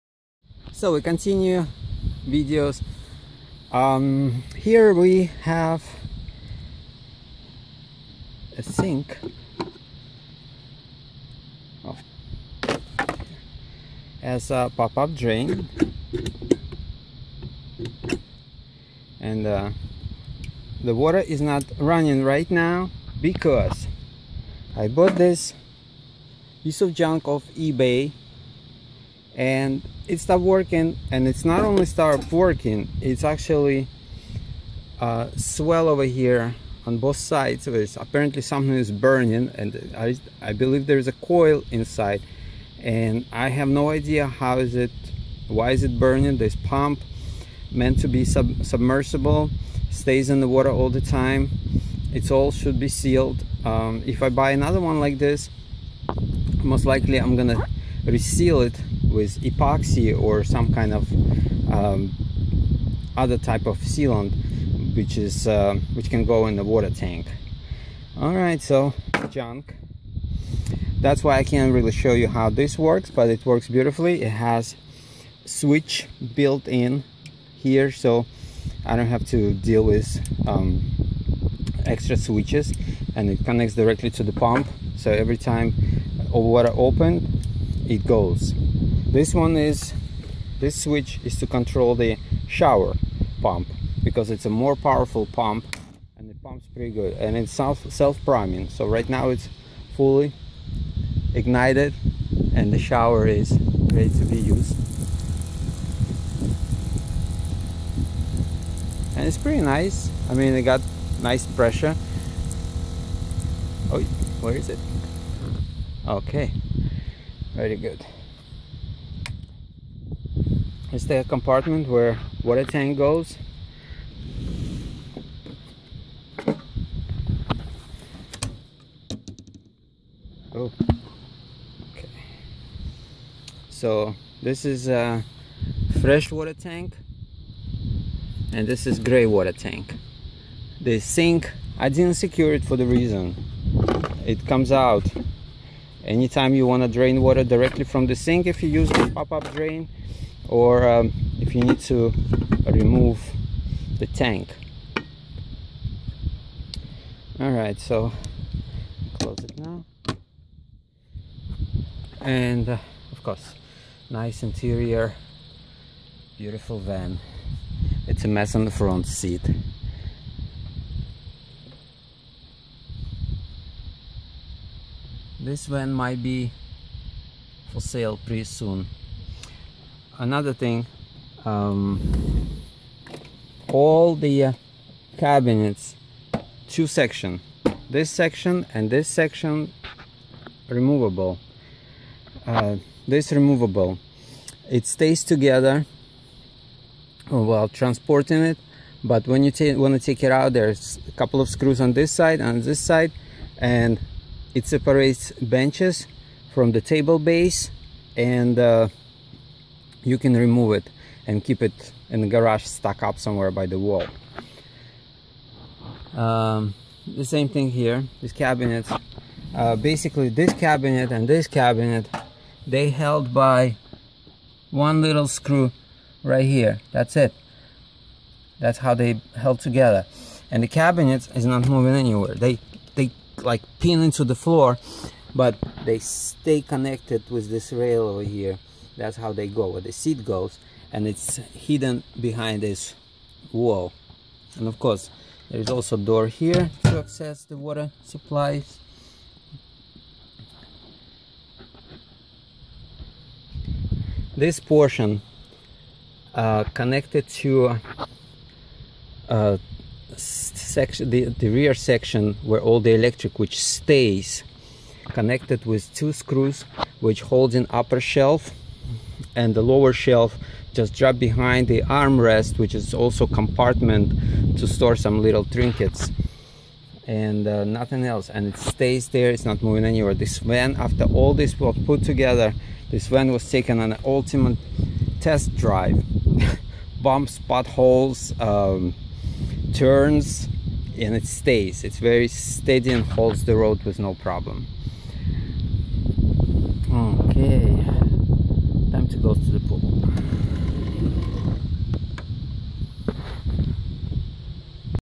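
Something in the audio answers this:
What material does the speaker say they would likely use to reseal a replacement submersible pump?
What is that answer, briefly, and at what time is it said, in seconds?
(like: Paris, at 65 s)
epoxy, at 59 s.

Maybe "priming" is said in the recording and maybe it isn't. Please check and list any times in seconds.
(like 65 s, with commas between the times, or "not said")
98 s.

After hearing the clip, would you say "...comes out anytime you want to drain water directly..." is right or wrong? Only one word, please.
right.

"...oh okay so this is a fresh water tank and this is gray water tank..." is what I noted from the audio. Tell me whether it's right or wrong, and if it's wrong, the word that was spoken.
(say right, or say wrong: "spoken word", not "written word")
right.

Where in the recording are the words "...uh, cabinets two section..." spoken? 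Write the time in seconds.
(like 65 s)
184 s.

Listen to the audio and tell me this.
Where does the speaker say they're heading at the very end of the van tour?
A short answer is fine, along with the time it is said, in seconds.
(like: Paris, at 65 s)
the pool, at 299 s.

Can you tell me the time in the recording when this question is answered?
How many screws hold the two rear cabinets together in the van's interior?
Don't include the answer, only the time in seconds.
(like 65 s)
224 s.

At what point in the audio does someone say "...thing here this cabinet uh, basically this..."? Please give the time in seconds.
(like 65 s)
217 s.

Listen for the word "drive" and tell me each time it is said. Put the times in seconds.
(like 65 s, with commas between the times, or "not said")
285 s.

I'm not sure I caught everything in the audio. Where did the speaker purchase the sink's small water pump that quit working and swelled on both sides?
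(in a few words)
eBay.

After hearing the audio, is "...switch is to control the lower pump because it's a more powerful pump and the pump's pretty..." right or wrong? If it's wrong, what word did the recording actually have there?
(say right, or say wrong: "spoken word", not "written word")
wrong: "shower", not "lower".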